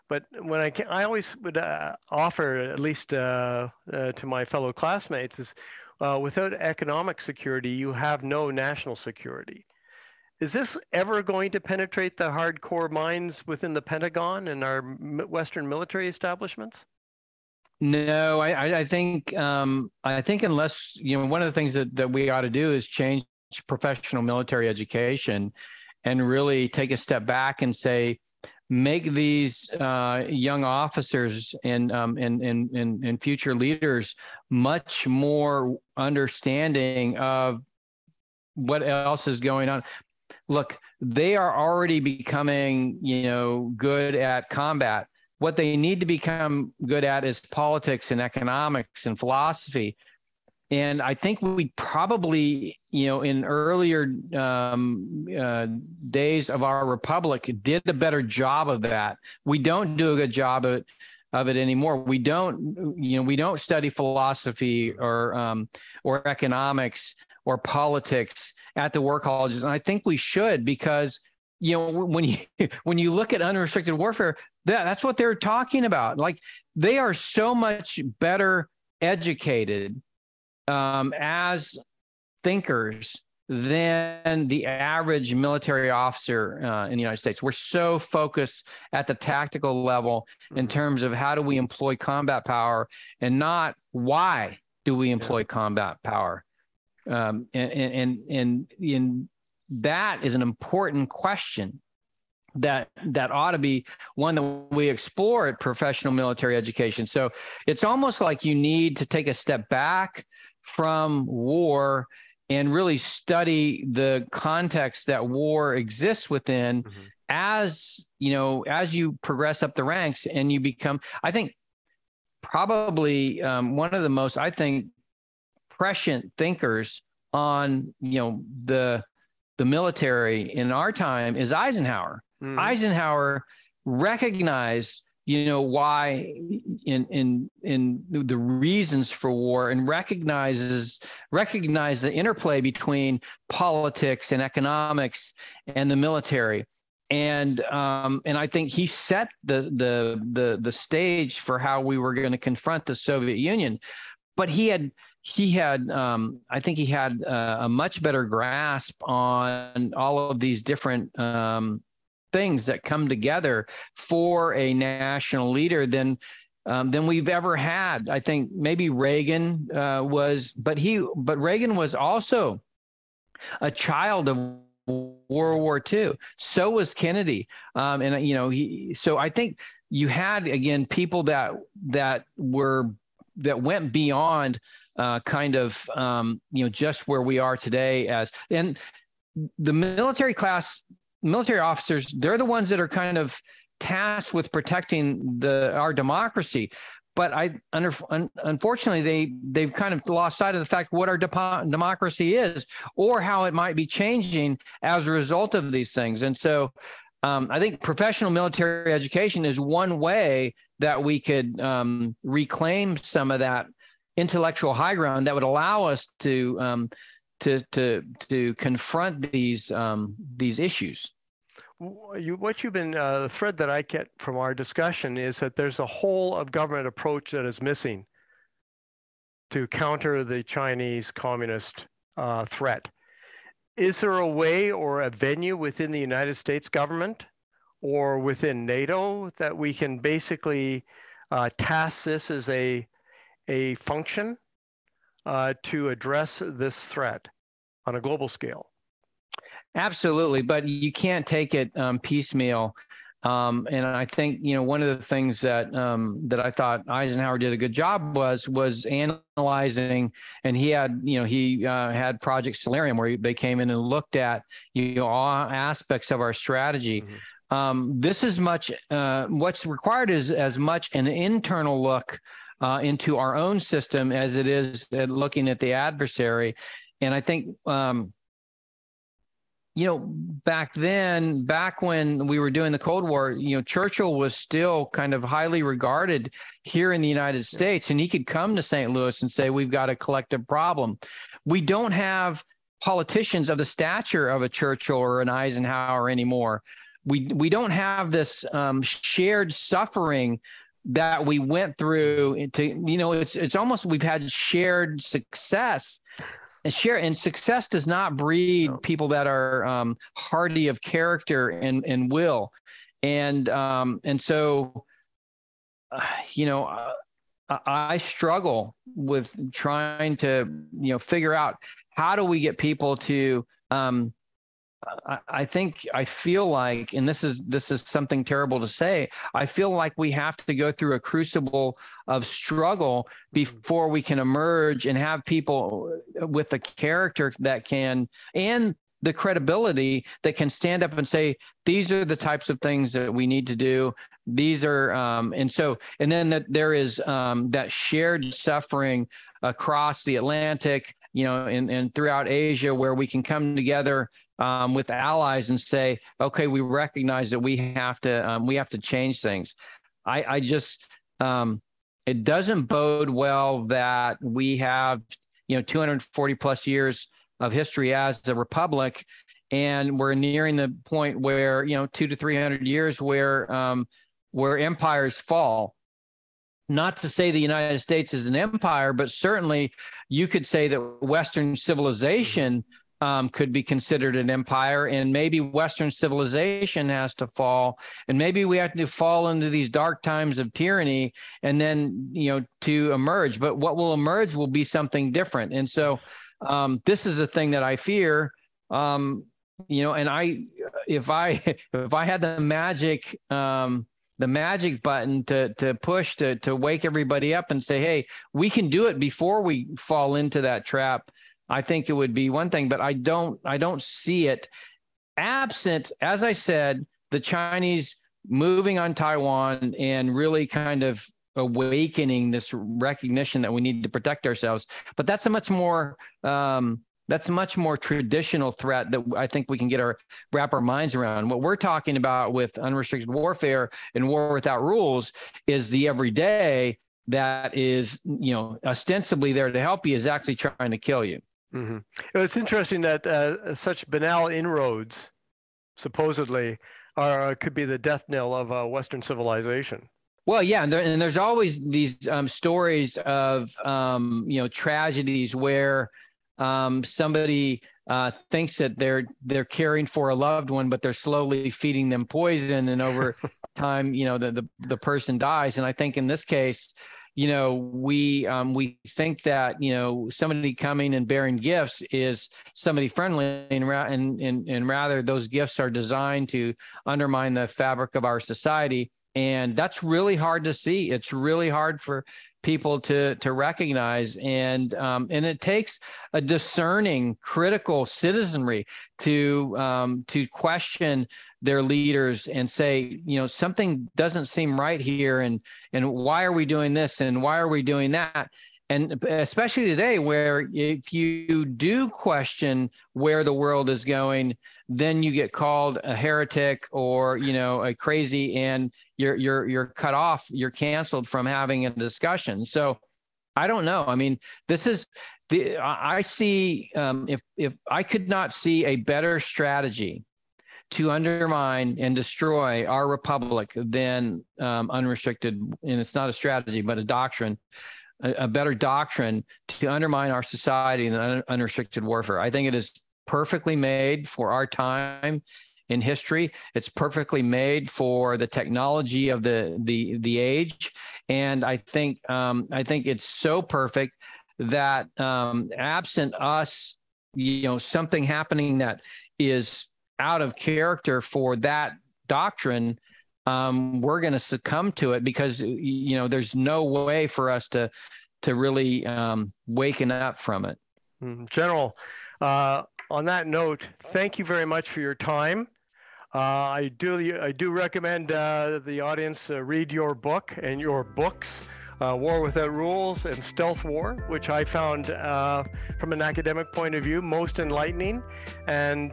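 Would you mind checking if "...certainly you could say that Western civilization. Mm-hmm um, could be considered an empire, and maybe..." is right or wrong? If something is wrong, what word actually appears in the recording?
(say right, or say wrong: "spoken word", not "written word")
right.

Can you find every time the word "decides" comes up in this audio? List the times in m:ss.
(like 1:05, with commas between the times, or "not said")
not said.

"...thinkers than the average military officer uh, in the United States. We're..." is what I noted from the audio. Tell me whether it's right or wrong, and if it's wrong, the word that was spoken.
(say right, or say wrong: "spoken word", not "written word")
right.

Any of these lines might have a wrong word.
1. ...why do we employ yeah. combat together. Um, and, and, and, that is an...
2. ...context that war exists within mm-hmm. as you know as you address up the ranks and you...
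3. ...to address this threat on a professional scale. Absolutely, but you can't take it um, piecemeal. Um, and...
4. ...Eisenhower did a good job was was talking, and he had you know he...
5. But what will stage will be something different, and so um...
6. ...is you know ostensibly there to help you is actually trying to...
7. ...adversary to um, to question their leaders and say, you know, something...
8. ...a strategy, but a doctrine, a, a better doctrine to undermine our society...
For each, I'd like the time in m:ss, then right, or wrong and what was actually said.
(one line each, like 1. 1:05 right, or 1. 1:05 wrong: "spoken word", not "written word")
1. 1:33 wrong: "power", not "together"
2. 1:54 wrong: "progress", not "address"
3. 4:05 wrong: "global", not "professional"
4. 4:16 wrong: "analyzing", not "talking"
5. 6:33 wrong: "emerge", not "stage"
6. 7:17 right
7. 8:07 wrong: "citizenry", not "adversary"
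8. 8:46 right.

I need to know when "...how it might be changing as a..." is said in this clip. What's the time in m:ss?
3:23.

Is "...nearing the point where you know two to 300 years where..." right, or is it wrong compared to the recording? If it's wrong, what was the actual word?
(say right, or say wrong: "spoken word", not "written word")
right.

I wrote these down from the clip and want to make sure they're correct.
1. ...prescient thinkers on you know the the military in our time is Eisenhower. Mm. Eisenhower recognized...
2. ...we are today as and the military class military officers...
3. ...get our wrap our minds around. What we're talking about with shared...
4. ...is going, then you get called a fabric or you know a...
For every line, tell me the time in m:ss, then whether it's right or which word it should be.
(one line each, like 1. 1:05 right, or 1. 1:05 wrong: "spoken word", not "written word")
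1. 2:05 right
2. 3:07 right
3. 7:09 wrong: "unrestricted", not "shared"
4. 8:23 wrong: "heretic", not "fabric".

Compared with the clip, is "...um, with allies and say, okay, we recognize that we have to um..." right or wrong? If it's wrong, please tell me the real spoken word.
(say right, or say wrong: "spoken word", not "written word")
right.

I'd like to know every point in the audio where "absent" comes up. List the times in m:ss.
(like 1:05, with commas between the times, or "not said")
6:55, 9:05.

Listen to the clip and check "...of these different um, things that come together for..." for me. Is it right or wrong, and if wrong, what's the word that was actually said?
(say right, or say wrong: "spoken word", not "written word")
right.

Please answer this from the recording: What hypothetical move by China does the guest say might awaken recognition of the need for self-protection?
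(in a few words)
moving on Taiwan.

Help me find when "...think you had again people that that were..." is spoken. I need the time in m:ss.
2:59.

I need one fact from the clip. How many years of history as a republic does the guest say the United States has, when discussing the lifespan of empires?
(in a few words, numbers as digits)
240 plus.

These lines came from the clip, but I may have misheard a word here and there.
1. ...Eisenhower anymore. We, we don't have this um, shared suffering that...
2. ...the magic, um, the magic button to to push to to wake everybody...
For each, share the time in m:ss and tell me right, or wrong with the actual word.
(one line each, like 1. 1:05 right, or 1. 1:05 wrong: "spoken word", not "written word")
1. 4:55 right
2. 6:42 right.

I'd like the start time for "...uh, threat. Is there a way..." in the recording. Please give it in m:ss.
3:52.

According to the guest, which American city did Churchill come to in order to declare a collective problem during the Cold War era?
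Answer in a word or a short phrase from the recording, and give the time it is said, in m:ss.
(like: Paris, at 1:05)
St. Louis, at 4:48.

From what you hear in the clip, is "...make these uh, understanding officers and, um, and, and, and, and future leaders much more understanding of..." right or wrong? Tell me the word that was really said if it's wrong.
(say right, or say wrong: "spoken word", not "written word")
wrong: "young", not "understanding".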